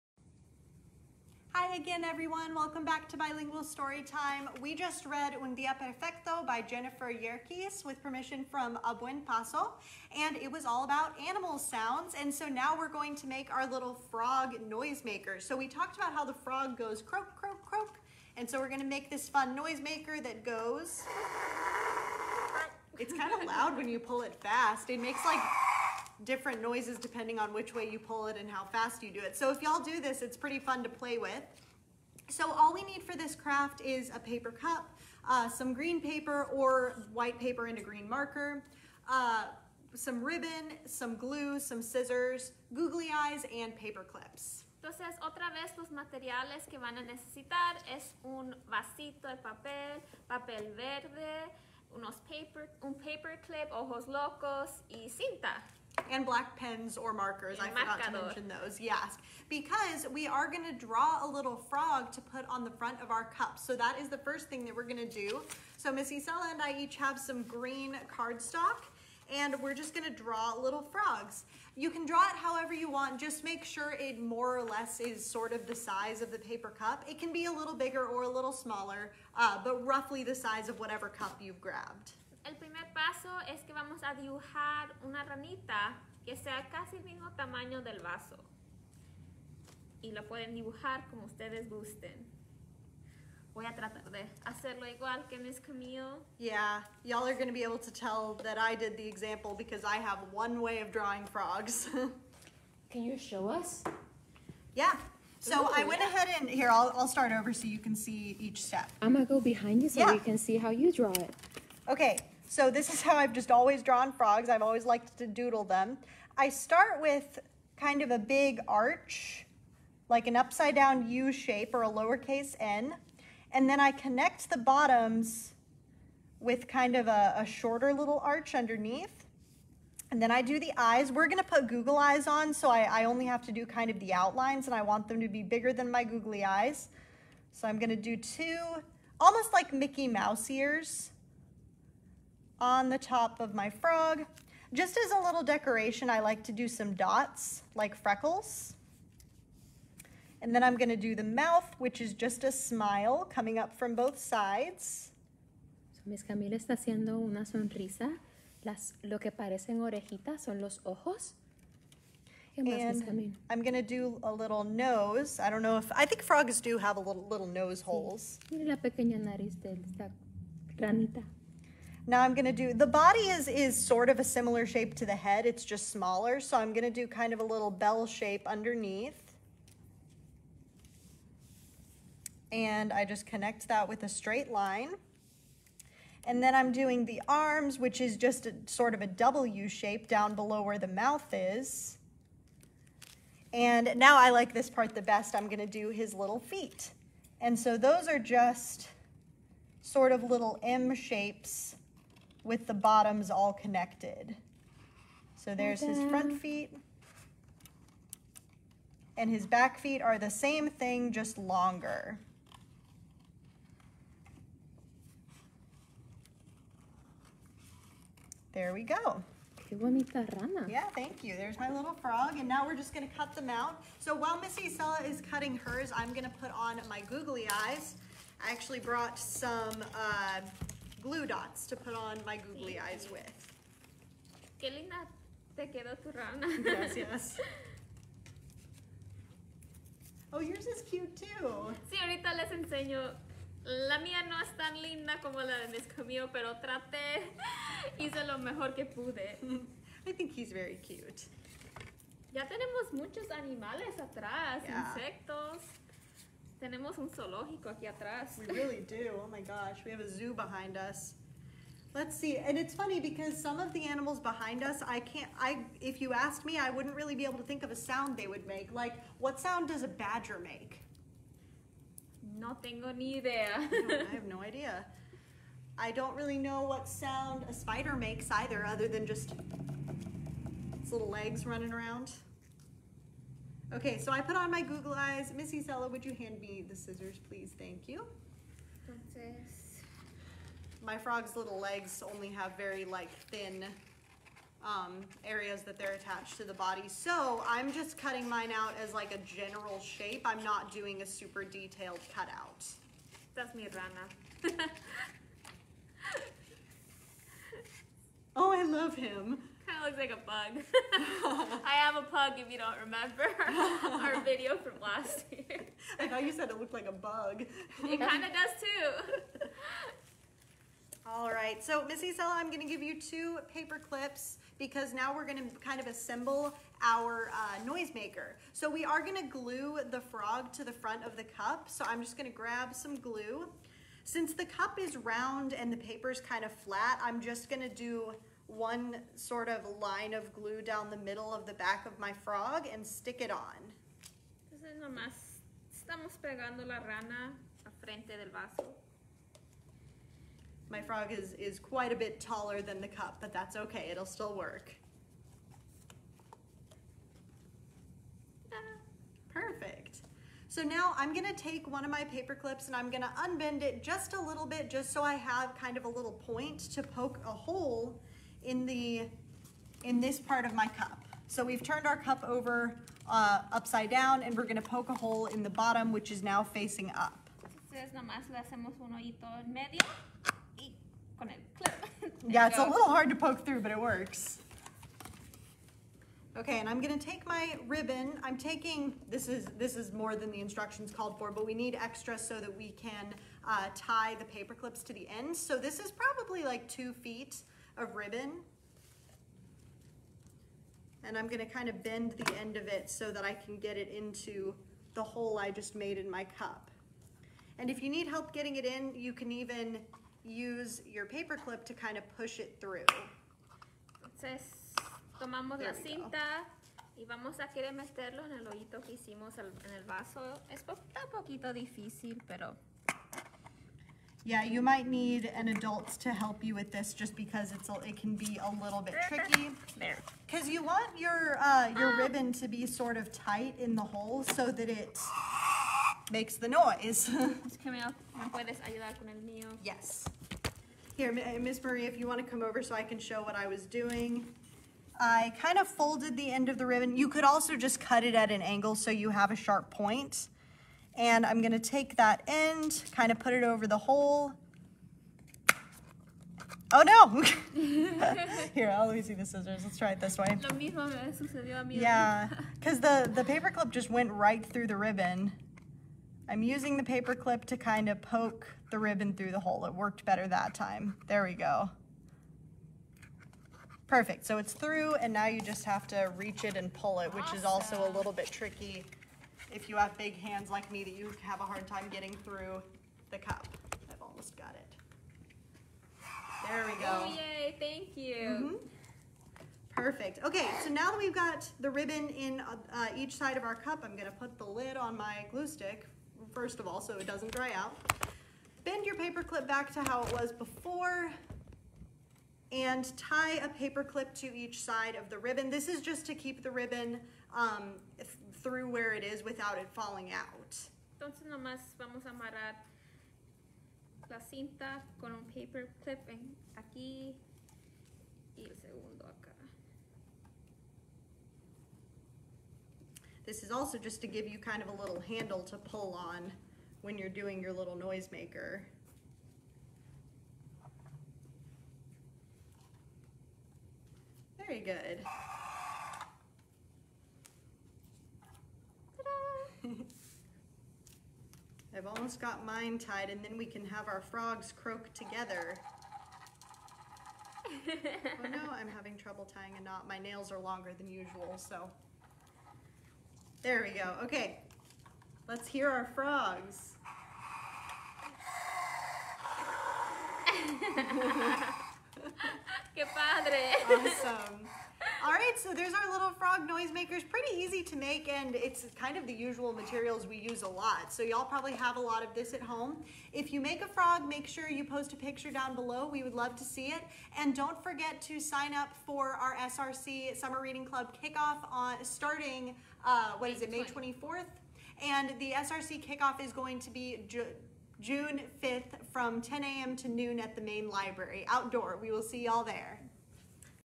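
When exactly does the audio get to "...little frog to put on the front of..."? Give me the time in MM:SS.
01:01.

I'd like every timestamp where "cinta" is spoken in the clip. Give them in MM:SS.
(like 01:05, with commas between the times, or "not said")
00:55, 06:55, 08:34.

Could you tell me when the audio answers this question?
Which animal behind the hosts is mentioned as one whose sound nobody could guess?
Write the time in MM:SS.
04:29.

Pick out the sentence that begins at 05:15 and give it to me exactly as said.
I thought you said it looked like a bug.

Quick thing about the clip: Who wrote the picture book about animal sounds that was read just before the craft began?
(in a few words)
Jennifer Yerkes.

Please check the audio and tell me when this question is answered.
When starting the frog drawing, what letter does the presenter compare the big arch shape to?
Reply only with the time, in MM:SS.
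02:01.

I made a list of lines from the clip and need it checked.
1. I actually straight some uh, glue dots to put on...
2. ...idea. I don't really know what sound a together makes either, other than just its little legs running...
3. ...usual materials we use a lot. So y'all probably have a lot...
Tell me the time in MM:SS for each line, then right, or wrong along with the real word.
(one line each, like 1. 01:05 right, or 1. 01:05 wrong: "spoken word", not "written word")
1. 03:48 wrong: "brought", not "straight"
2. 04:34 wrong: "spider", not "together"
3. 09:29 right.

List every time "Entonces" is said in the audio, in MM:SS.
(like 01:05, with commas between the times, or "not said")
00:44, 04:48, 05:44, 06:54, 08:30.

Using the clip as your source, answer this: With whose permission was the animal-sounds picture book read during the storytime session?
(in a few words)
A Buen Paso.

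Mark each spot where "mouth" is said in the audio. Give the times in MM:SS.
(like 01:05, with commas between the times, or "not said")
02:31, 03:10.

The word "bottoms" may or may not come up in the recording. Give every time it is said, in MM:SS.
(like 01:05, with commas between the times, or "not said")
02:04, 03:22, 06:15.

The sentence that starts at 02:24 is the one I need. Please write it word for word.
Just as a little decoration, I like to do some dots, like freckles.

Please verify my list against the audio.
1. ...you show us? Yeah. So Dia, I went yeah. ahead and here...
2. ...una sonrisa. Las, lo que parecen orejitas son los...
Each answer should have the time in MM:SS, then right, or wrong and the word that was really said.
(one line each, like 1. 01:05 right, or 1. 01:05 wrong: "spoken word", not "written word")
1. 01:43 wrong: "Ooh", not "Dia"
2. 02:37 right.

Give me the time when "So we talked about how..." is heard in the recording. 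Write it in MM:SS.
00:15.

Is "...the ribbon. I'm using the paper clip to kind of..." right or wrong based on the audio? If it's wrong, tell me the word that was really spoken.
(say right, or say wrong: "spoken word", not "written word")
right.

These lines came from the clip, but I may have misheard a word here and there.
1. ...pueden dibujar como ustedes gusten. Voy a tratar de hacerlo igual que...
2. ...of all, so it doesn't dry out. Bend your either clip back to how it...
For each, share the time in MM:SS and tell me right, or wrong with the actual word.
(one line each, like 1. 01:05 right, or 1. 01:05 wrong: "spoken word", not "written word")
1. 01:30 right
2. 08:16 wrong: "paper", not "either".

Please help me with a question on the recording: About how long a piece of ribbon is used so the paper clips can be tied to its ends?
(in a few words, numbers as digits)
Two feet.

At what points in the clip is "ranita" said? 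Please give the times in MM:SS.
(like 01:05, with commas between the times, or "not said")
01:25, 02:50.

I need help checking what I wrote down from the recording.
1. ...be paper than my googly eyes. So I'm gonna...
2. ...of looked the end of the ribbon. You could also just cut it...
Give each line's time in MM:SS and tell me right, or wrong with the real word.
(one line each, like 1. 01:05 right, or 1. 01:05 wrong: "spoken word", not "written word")
1. 02:15 wrong: "bigger", not "paper"
2. 07:25 wrong: "folded", not "looked".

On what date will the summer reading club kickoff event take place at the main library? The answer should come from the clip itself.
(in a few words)
June 5th.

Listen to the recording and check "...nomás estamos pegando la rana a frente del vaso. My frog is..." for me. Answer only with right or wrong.
right.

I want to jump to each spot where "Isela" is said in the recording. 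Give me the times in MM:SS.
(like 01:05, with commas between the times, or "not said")
01:06, 03:44, 04:45, 05:22.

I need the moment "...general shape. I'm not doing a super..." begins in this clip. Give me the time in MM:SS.
04:59.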